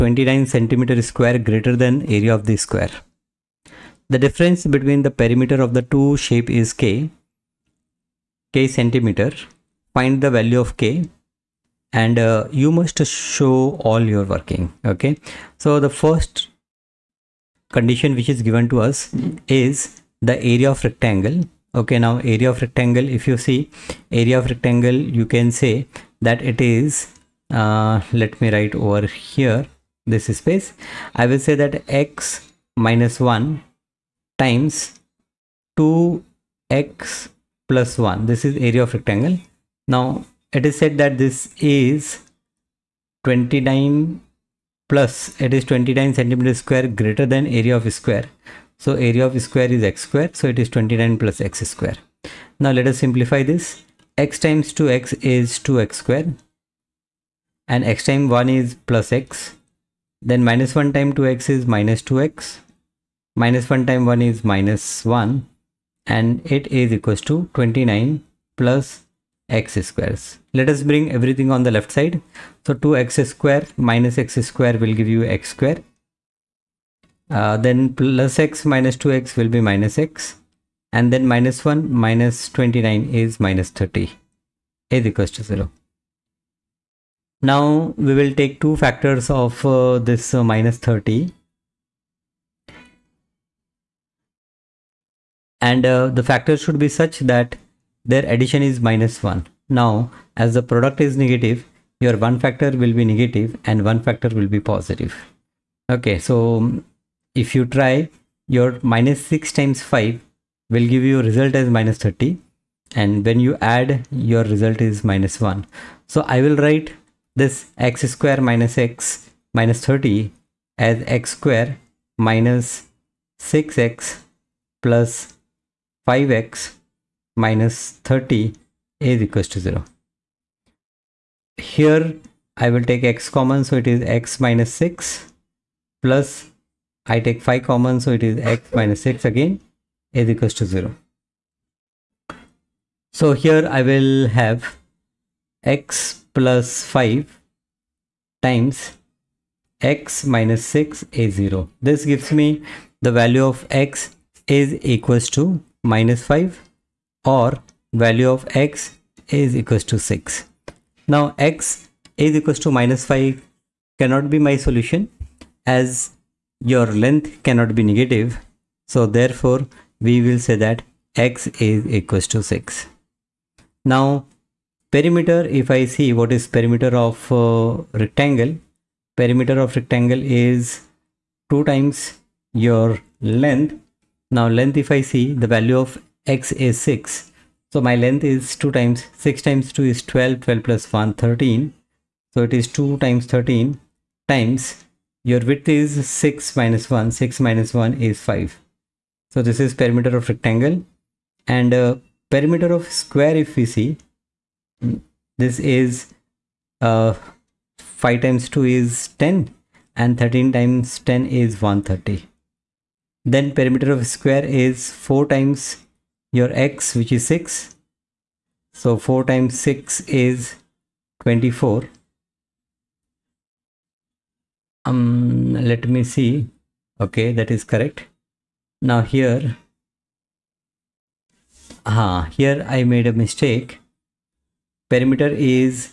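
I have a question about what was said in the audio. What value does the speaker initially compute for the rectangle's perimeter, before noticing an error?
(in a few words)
130.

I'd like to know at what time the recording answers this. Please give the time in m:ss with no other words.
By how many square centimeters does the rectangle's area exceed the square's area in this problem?
0:45.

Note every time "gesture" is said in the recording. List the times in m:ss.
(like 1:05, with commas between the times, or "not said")
not said.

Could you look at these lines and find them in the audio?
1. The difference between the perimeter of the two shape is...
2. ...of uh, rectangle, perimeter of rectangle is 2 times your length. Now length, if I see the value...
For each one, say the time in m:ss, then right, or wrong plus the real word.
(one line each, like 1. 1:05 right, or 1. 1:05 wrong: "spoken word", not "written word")
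1. 0:04 right
2. 2:56 right.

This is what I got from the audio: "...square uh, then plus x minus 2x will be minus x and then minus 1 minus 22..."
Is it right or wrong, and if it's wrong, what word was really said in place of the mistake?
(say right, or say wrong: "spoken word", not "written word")
wrong: "29", not "22".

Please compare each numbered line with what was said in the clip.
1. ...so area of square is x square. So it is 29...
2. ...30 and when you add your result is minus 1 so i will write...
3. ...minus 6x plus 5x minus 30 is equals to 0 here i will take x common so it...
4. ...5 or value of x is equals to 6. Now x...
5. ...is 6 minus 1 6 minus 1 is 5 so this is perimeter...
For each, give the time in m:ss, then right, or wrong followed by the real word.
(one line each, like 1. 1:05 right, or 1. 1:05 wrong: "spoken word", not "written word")
1. 0:48 right
2. 1:52 right
3. 2:02 right
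4. 2:36 right
5. 3:15 right.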